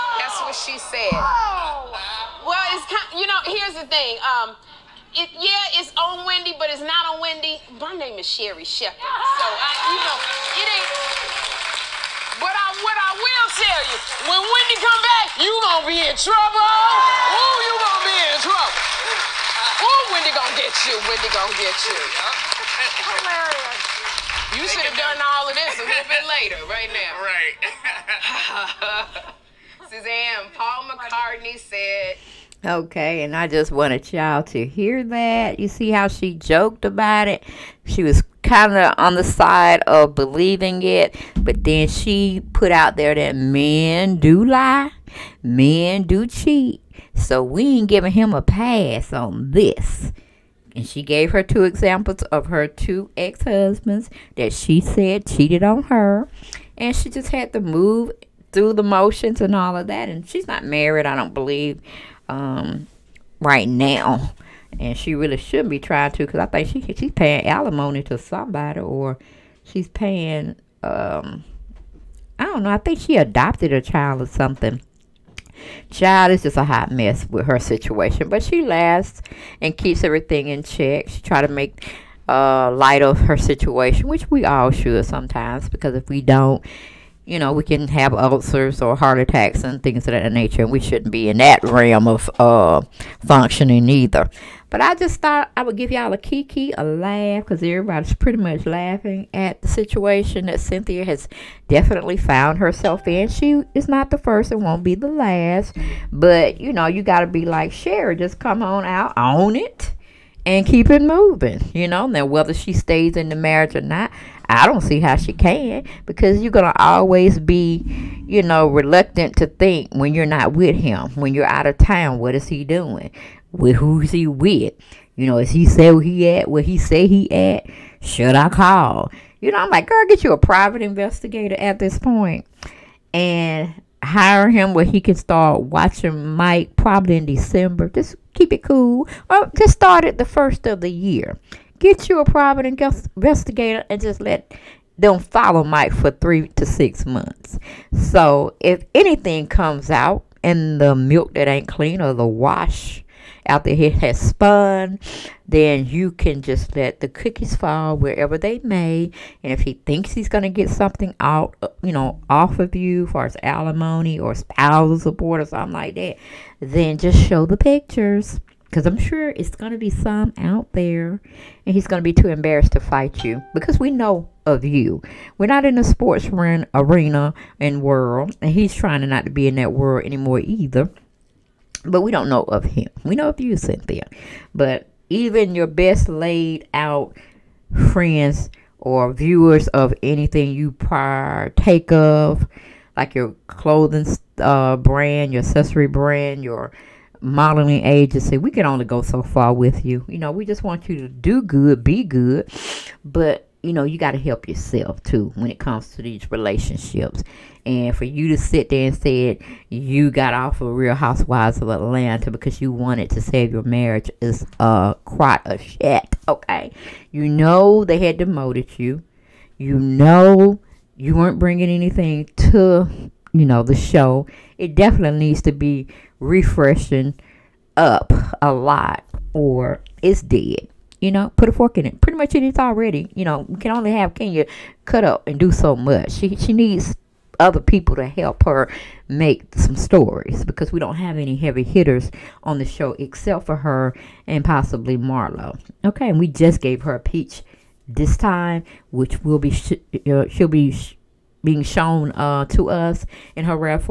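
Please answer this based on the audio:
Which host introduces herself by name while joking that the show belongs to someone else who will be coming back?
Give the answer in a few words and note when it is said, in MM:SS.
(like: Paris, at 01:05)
Sherry Shepherd, at 00:08.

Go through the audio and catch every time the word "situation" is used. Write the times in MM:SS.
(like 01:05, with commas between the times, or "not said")
01:17, 01:23, 01:39.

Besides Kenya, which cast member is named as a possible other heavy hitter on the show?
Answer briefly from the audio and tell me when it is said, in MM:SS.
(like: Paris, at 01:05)
Marlo, at 04:04.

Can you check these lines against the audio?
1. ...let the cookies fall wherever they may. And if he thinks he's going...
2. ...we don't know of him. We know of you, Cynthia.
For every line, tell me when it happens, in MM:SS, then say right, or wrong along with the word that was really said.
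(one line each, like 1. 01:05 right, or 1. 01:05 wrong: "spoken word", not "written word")
1. 02:36 right
2. 03:02 right.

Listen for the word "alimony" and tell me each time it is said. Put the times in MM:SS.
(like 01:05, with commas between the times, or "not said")
01:07, 02:43.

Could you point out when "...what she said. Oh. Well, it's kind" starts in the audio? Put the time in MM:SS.
00:00.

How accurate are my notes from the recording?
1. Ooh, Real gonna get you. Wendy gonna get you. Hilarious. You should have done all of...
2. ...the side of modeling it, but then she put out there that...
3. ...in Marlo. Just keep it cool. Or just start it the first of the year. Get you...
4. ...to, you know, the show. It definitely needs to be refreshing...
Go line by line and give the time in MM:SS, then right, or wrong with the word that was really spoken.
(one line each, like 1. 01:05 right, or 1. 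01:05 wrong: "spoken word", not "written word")
1. 00:19 wrong: "Wendy", not "Real"
2. 00:39 wrong: "believing", not "modeling"
3. 02:17 wrong: "December", not "Marlo"
4. 03:42 right.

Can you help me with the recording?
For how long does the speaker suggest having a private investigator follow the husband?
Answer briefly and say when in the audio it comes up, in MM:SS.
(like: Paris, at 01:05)
3 to 6 months, at 02:26.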